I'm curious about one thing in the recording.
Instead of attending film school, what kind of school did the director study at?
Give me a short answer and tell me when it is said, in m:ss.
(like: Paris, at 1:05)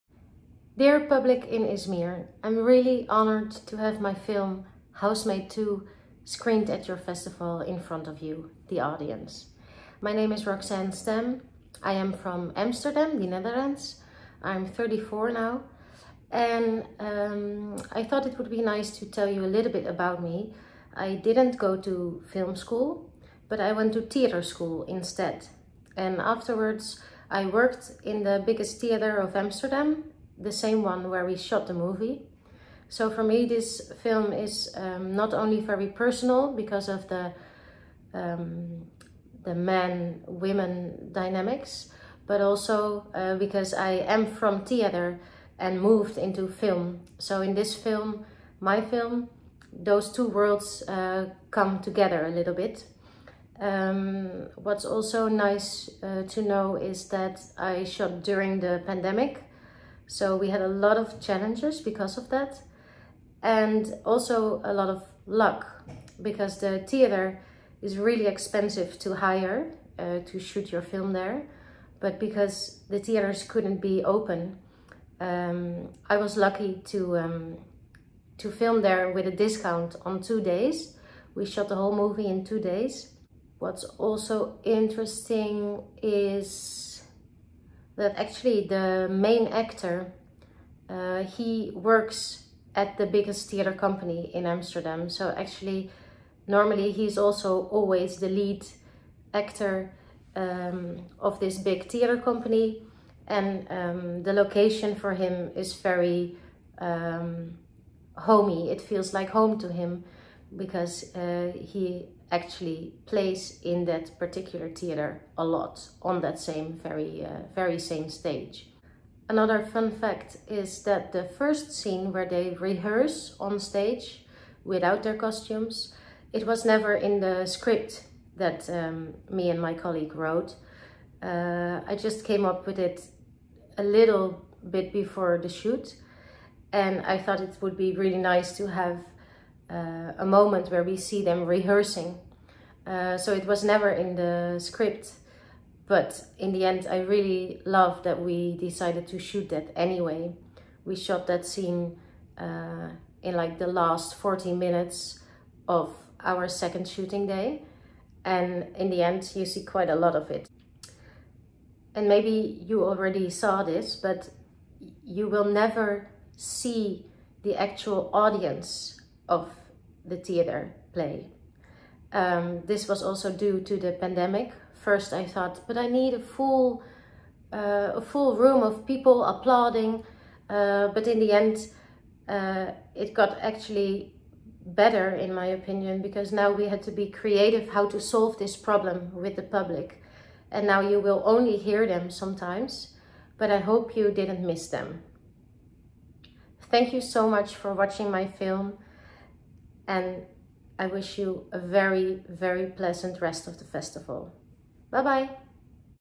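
theater school, at 0:24.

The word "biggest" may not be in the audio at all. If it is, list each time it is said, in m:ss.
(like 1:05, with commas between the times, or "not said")
0:28, 1:33.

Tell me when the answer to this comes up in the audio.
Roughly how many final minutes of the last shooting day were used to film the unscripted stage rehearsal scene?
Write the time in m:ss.
2:34.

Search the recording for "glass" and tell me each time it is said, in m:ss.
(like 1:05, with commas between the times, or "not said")
not said.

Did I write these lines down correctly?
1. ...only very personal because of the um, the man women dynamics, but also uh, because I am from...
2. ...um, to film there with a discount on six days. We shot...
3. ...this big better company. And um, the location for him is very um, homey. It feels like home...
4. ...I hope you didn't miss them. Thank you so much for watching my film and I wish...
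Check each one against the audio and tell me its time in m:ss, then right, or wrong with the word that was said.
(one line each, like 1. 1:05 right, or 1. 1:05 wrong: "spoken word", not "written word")
1. 0:35 right
2. 1:17 wrong: "two", not "six"
3. 1:41 wrong: "theater", not "better"
4. 3:13 right.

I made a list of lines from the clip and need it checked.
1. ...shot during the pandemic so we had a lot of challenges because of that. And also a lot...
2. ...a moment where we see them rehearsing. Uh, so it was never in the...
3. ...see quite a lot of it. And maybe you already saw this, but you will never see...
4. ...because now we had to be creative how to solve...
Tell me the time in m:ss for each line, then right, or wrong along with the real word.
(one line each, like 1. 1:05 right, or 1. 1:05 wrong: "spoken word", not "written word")
1. 0:57 right
2. 2:20 right
3. 2:39 right
4. 3:06 right.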